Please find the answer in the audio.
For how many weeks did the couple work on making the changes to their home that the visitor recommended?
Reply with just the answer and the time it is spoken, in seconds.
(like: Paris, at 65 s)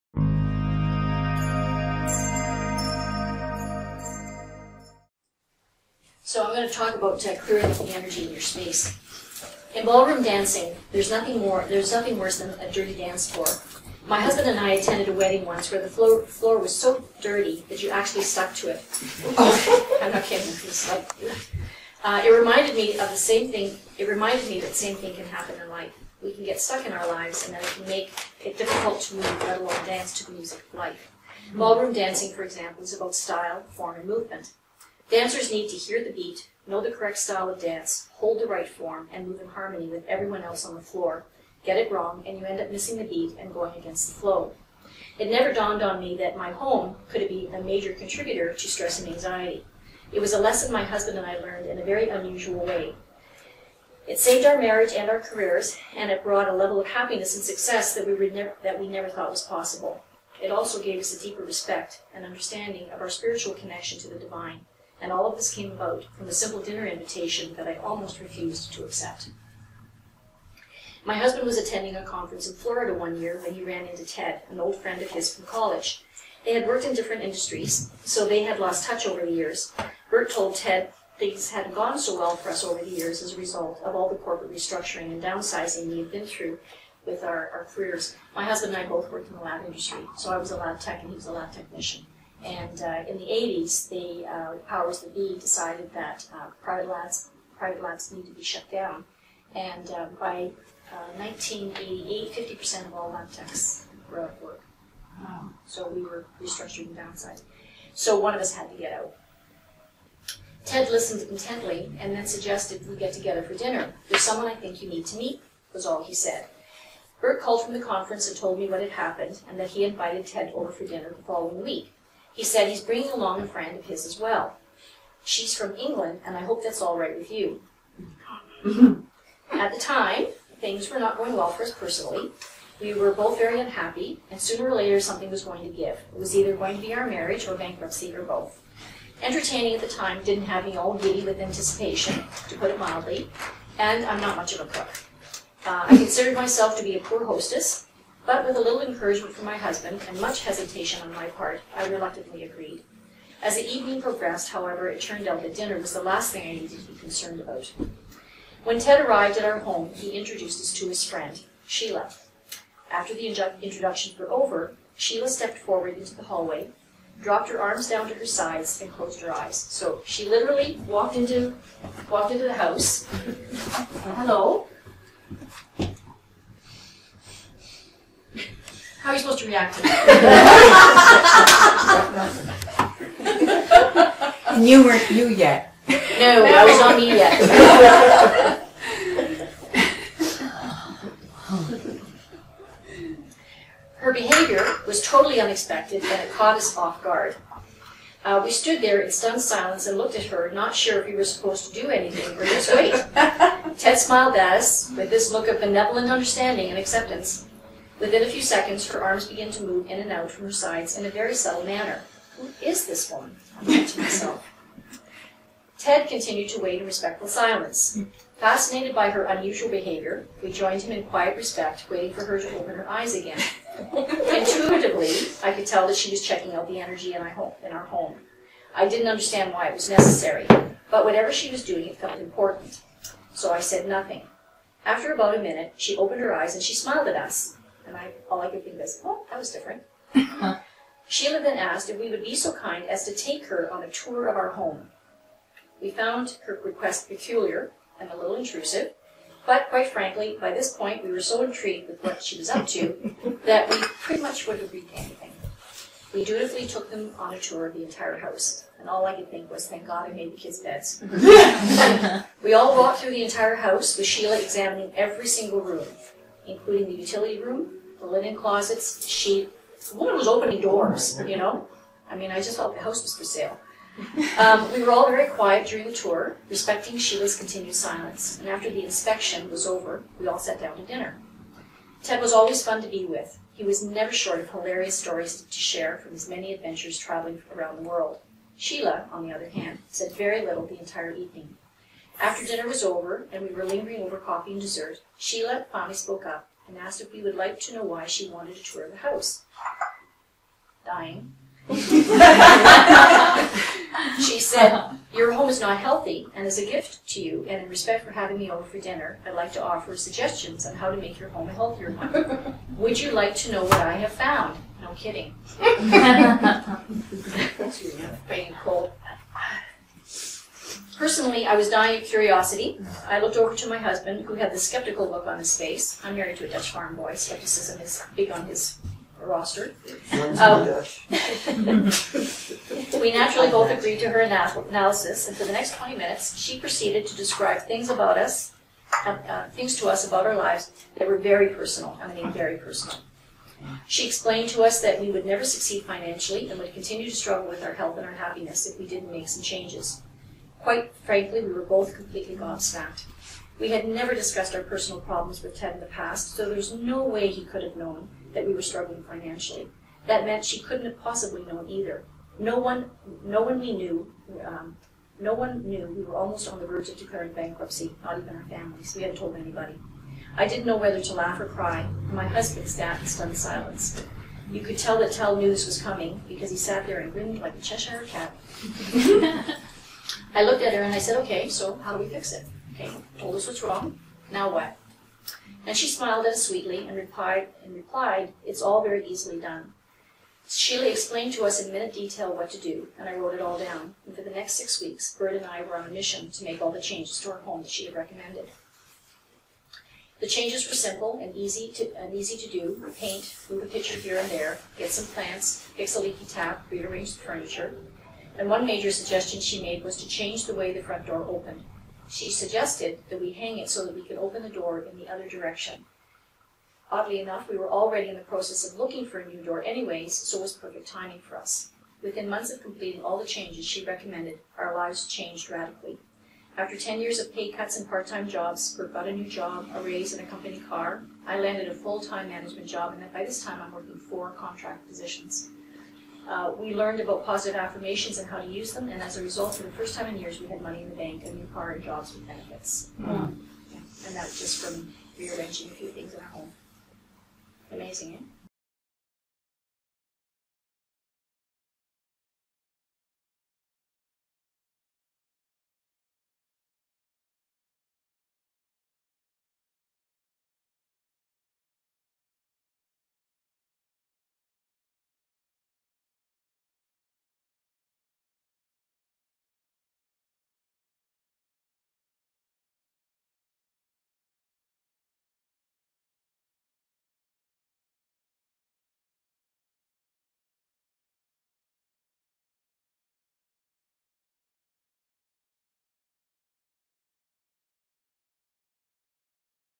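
6, at 394 s.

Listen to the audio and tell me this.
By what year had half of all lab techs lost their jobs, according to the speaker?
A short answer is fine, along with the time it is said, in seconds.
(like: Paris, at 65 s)
1988, at 101 s.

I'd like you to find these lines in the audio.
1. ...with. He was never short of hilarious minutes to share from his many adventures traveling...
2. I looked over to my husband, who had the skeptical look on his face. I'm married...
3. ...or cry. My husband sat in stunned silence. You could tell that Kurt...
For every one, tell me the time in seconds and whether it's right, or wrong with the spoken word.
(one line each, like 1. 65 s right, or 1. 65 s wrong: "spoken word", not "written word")
1. 283 s wrong: "stories", not "minutes"
2. 323 s right
3. 371 s wrong: "Ted", not "Kurt".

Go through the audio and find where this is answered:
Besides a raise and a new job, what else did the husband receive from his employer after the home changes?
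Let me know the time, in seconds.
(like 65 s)
430 s.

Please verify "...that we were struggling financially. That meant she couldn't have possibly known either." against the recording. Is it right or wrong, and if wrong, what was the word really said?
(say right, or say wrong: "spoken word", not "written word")
right.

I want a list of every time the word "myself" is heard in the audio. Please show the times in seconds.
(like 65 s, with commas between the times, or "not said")
146 s, 213 s.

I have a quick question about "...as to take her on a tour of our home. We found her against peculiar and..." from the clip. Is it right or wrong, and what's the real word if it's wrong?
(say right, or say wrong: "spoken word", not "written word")
wrong: "request", not "against".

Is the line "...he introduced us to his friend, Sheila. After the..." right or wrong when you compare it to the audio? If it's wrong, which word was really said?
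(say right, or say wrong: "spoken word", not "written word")
right.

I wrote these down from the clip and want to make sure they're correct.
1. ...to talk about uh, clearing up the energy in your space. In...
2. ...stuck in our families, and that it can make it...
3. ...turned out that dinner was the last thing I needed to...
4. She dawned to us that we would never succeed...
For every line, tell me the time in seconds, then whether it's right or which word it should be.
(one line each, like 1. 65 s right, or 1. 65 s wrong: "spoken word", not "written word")
1. 6 s right
2. 26 s wrong: "lives", not "families"
3. 155 s right
4. 343 s wrong: "explained", not "dawned".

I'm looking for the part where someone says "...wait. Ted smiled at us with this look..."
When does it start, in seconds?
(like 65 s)
202 s.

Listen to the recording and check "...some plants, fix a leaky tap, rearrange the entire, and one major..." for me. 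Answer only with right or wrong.
wrong.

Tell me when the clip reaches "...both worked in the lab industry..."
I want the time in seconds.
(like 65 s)
88 s.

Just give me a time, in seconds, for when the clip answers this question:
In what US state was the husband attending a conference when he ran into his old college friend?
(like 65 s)
72 s.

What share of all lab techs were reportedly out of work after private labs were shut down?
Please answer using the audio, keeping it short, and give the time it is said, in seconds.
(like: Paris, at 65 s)
50%, at 102 s.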